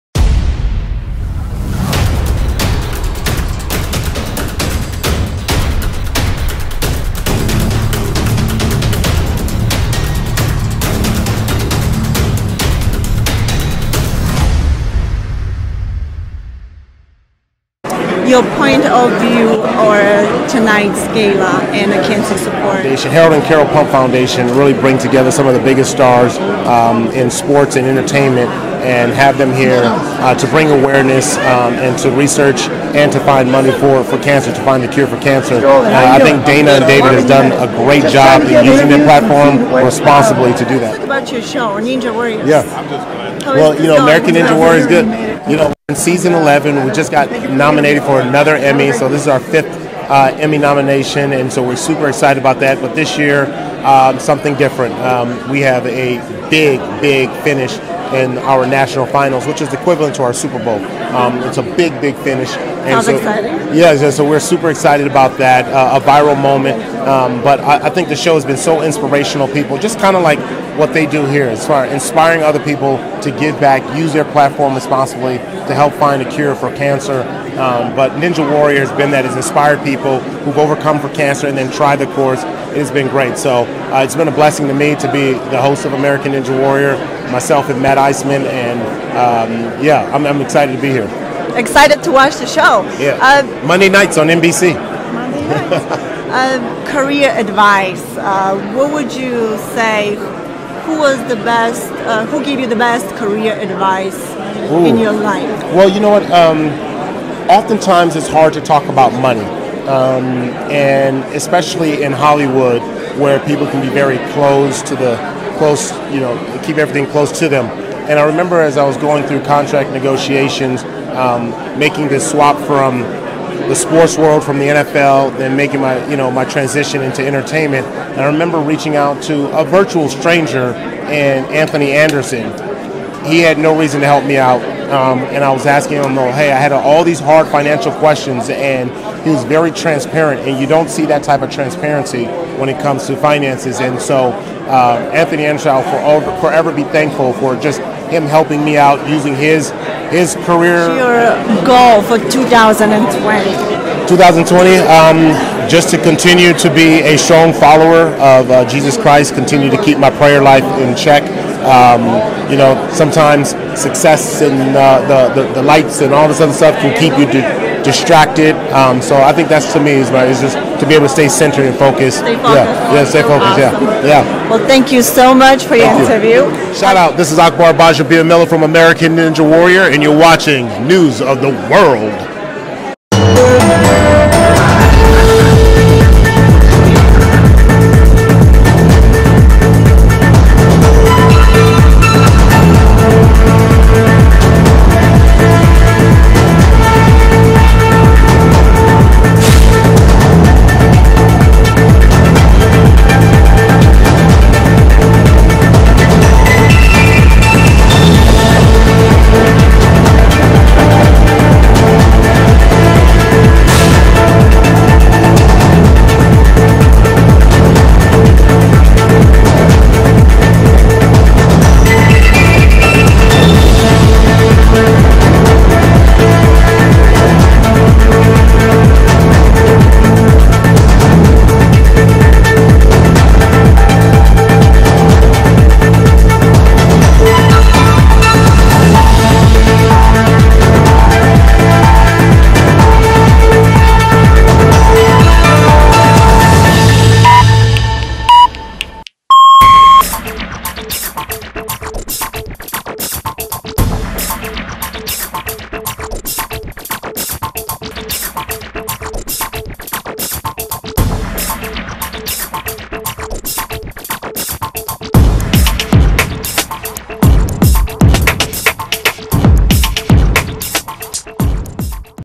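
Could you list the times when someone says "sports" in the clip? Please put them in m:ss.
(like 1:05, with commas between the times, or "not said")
0:27, 2:03.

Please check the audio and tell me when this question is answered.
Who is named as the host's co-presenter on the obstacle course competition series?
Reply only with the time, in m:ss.
1:27.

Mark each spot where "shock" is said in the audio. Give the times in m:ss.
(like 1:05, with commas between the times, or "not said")
not said.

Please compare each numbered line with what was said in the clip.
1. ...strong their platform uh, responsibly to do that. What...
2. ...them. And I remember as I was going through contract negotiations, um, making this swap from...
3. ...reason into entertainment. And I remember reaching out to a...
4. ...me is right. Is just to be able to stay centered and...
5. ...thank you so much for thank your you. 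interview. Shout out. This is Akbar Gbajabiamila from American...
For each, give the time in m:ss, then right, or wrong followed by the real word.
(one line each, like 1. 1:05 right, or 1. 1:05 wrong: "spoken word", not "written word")
1. 0:38 wrong: "using", not "strong"
2. 1:57 right
3. 2:06 wrong: "transition", not "reason"
4. 2:49 right
5. 2:54 right.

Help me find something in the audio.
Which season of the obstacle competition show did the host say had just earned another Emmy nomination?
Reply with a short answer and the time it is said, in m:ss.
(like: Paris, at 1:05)
11, at 0:45.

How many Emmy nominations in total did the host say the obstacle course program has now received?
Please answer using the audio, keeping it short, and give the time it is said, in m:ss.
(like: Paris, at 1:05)
5, at 0:49.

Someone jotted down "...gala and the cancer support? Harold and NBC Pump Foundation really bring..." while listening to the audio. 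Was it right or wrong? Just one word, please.
wrong.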